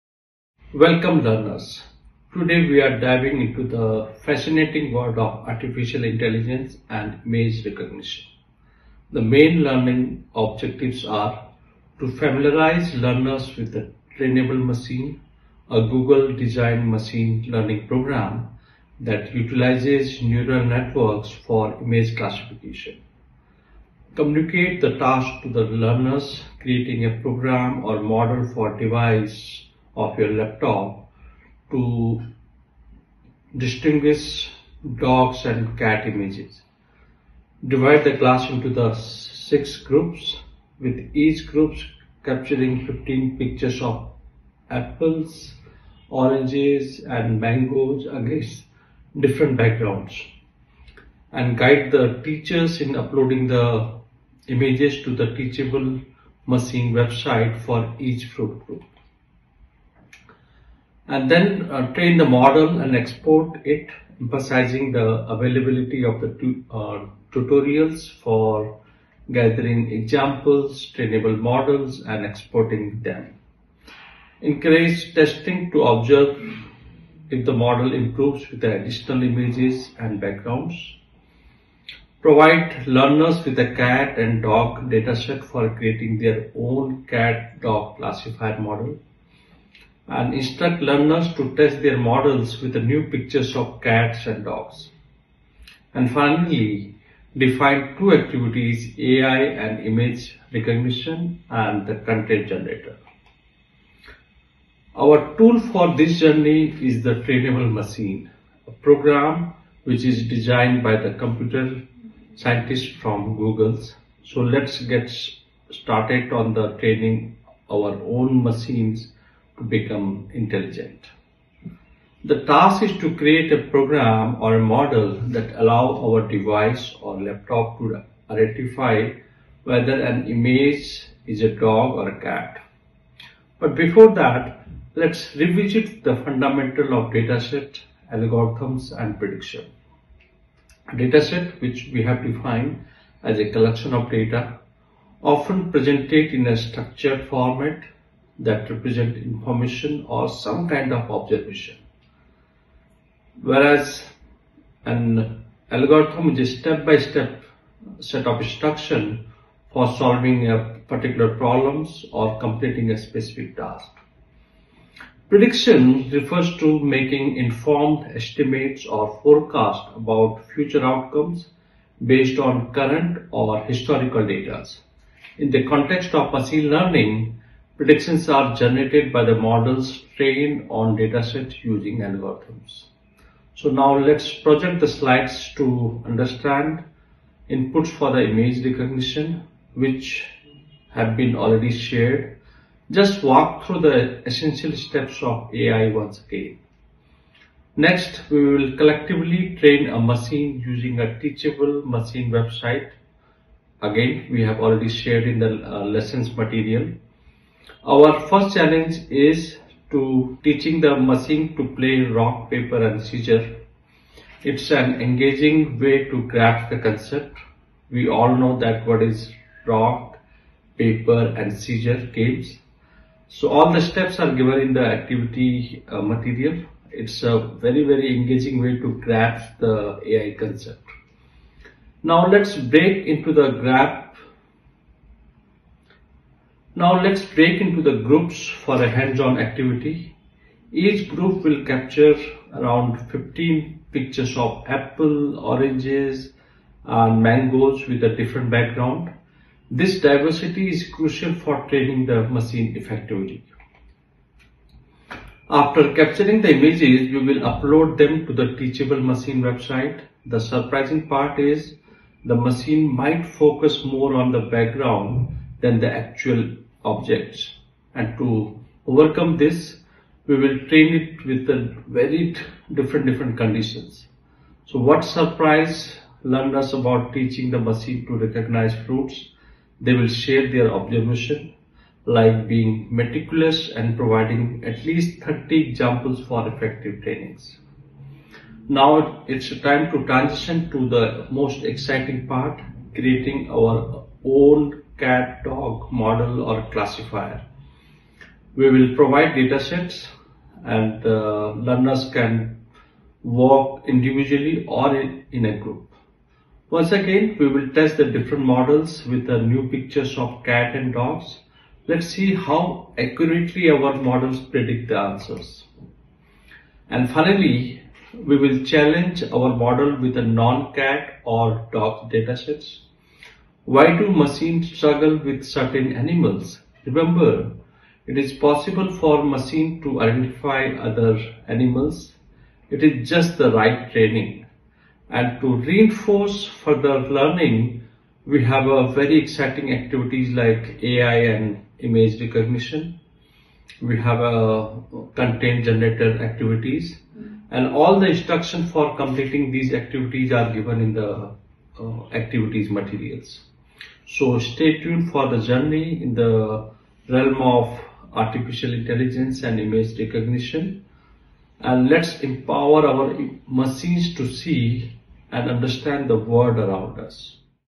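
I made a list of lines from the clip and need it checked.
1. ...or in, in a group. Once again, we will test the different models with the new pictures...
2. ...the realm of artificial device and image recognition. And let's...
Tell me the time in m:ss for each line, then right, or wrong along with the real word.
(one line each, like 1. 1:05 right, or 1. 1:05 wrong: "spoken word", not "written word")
1. 5:04 right
2. 5:56 wrong: "intelligence", not "device".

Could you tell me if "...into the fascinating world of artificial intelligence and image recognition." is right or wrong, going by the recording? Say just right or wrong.
right.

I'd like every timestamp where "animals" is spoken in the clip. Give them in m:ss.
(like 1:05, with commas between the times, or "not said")
5:25, 5:31.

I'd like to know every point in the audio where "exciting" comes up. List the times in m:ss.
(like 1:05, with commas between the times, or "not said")
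4:51, 5:39.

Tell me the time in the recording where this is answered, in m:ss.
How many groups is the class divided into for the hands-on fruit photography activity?
0:38.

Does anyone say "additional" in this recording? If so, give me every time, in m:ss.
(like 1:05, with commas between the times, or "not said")
1:18.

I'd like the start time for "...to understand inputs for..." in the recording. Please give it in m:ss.
3:05.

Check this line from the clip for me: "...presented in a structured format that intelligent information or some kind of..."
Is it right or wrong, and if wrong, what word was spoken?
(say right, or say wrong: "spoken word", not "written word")
wrong: "represent", not "intelligent".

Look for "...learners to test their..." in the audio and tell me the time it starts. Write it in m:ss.
1:30.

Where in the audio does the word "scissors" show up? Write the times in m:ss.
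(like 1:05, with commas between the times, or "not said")
3:33, 3:41.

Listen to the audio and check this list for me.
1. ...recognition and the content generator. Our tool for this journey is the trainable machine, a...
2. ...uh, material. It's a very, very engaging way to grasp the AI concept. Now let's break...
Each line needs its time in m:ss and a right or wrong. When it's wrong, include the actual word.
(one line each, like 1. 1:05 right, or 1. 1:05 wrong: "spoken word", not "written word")
1. 1:40 right
2. 3:45 right.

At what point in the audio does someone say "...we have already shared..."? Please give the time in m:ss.
3:24.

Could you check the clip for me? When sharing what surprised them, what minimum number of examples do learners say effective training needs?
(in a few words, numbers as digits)
30.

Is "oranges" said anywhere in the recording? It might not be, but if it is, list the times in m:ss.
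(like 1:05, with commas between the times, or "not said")
0:46, 4:05.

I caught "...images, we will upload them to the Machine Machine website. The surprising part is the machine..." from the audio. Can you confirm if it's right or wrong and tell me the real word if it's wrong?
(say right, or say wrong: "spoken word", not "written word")
wrong: "Teachable", not "Machine".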